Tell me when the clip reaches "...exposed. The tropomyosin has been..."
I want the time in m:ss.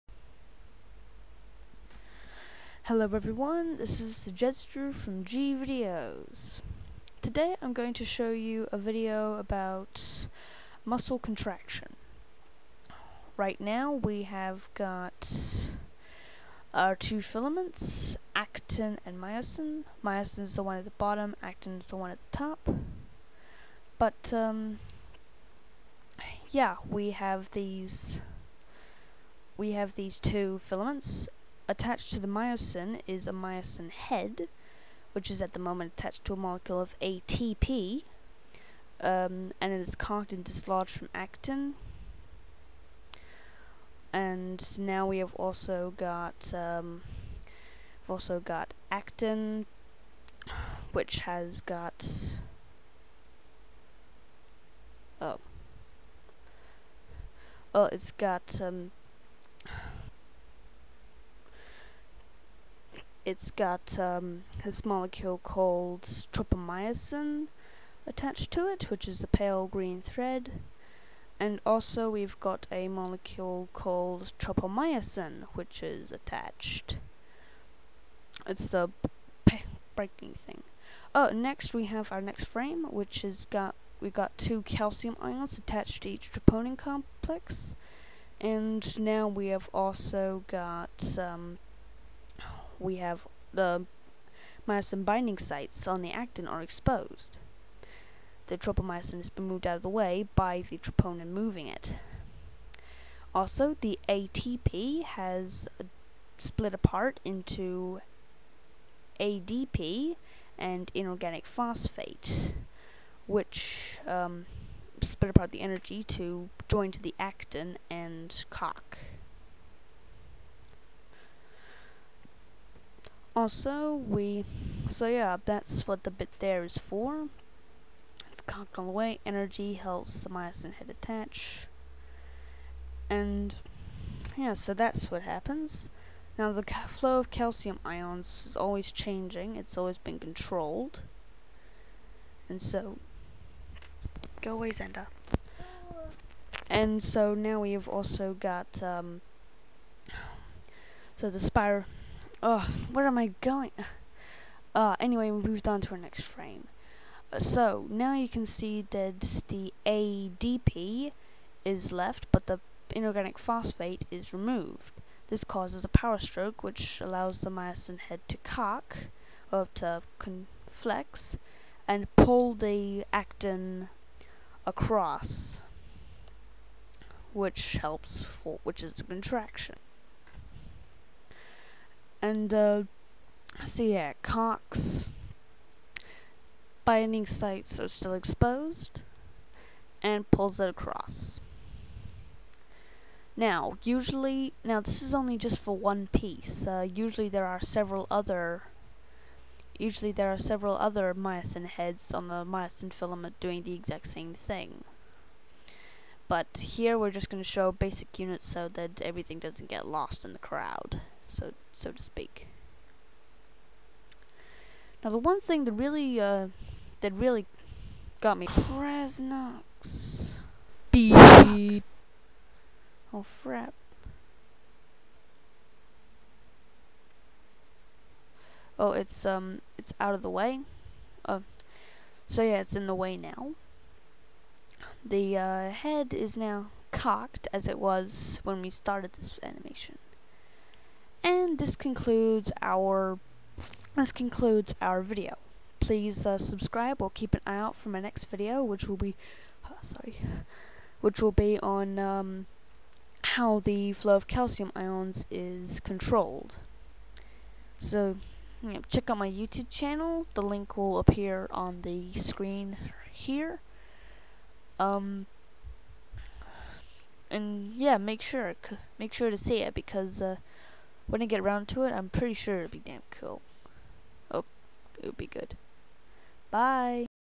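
1:36.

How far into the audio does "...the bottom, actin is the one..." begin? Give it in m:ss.
0:20.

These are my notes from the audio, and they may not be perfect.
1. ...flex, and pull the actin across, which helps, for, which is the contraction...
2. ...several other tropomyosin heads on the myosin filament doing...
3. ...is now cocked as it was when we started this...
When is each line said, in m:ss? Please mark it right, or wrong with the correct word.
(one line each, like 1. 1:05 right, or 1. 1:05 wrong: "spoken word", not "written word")
1. 2:50 right
2. 3:20 wrong: "myosin", not "tropomyosin"
3. 3:56 right.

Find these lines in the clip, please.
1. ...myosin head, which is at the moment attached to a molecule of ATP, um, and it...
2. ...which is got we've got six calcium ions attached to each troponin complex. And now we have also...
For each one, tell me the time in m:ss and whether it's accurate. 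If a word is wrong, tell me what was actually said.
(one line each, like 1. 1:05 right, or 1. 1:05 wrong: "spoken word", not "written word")
1. 0:33 right
2. 1:22 wrong: "two", not "six".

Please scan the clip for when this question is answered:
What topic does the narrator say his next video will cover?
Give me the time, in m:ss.
4:13.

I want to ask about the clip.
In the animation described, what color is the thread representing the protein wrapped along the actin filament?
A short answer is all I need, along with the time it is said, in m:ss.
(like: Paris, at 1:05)
pale green, at 1:09.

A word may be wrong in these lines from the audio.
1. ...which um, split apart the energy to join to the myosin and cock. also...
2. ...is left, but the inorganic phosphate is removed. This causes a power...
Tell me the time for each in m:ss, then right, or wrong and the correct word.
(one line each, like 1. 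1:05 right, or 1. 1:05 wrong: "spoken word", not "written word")
1. 1:53 wrong: "actin", not "myosin"
2. 2:41 right.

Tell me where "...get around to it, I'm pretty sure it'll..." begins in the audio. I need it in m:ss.
4:31.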